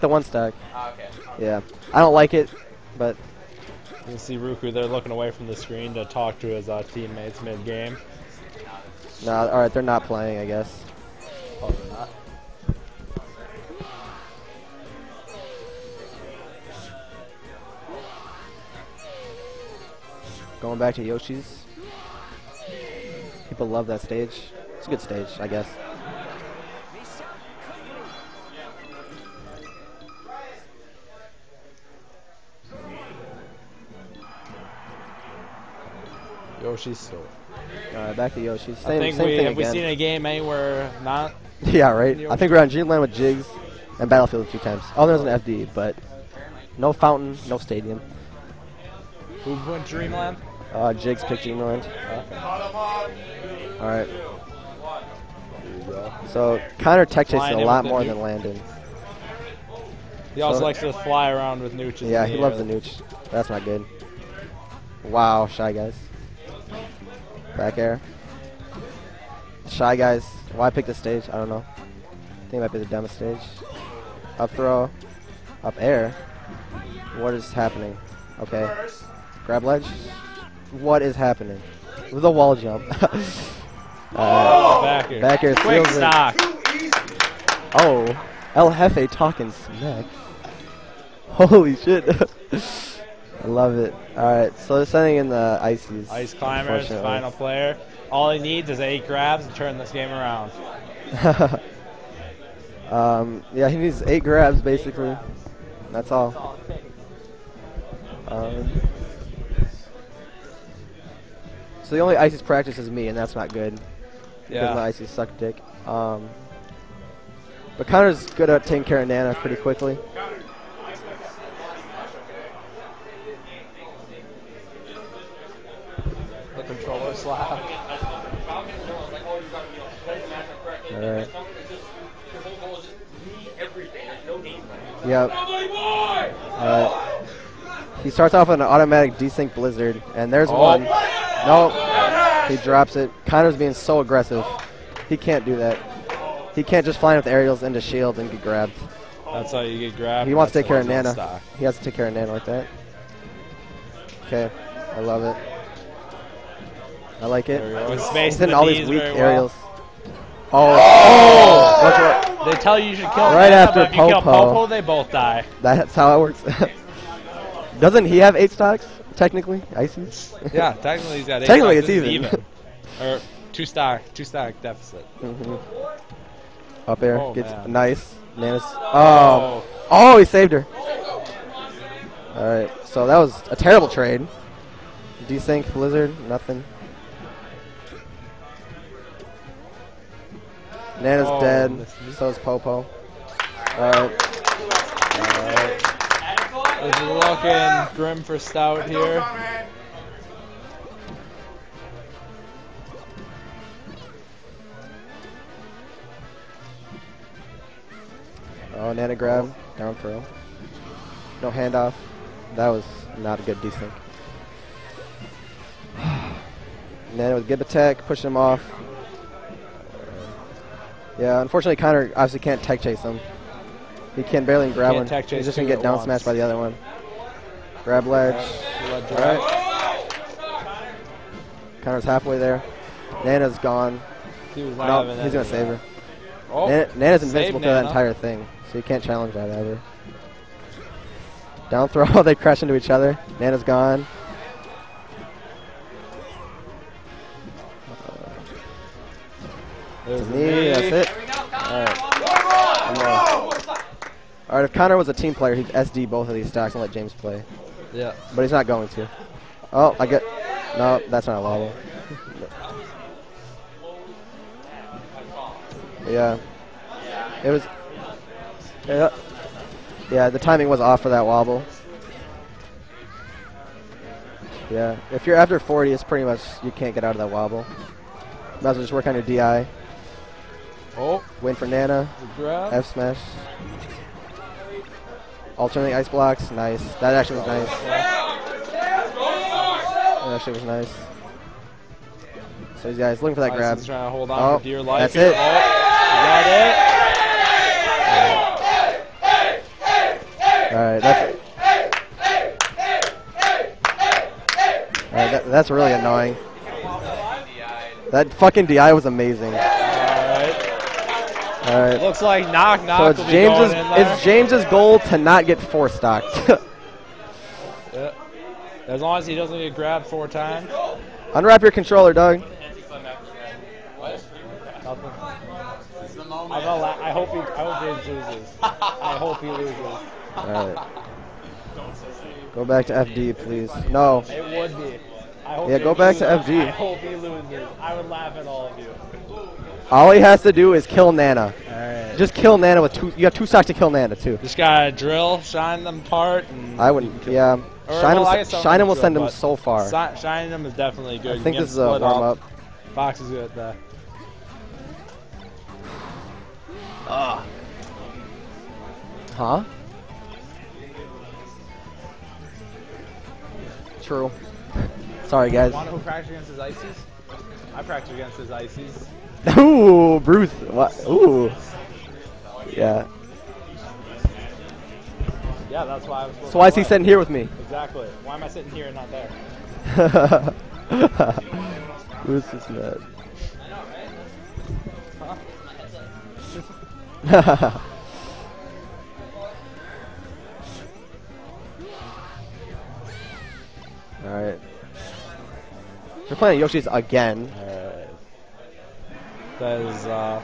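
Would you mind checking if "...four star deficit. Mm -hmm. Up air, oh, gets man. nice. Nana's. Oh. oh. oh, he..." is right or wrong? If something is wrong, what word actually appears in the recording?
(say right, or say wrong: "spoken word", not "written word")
wrong: "two", not "four".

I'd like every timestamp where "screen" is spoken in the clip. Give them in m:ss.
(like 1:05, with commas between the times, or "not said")
0:05.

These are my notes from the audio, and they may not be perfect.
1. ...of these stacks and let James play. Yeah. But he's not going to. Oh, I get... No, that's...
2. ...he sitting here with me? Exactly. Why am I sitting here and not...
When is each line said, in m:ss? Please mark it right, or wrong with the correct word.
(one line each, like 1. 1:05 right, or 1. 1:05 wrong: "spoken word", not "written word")
1. 4:16 right
2. 6:16 right.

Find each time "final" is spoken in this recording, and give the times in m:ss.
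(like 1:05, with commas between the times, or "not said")
1:36.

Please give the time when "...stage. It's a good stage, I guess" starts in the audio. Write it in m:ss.
0:24.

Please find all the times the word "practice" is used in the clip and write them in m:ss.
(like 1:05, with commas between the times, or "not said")
1:52, 6:07.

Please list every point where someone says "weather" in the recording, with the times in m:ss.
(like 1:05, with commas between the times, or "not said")
not said.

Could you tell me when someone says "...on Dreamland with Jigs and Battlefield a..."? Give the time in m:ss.
0:42.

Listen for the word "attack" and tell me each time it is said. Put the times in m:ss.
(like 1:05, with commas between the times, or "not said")
3:37.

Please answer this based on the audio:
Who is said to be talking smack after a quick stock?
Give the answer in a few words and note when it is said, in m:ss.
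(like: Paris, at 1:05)
El Jefe, at 1:28.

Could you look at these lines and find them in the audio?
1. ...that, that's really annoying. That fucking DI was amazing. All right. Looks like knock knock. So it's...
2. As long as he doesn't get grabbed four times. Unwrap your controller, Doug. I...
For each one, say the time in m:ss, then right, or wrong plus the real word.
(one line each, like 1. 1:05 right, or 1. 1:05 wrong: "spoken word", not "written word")
1. 5:05 right
2. 5:18 right.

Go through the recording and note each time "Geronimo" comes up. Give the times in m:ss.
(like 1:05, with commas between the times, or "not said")
not said.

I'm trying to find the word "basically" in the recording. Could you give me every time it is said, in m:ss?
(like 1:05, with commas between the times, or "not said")
1:44.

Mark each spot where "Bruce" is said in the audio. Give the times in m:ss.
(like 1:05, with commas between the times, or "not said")
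6:10, 6:22.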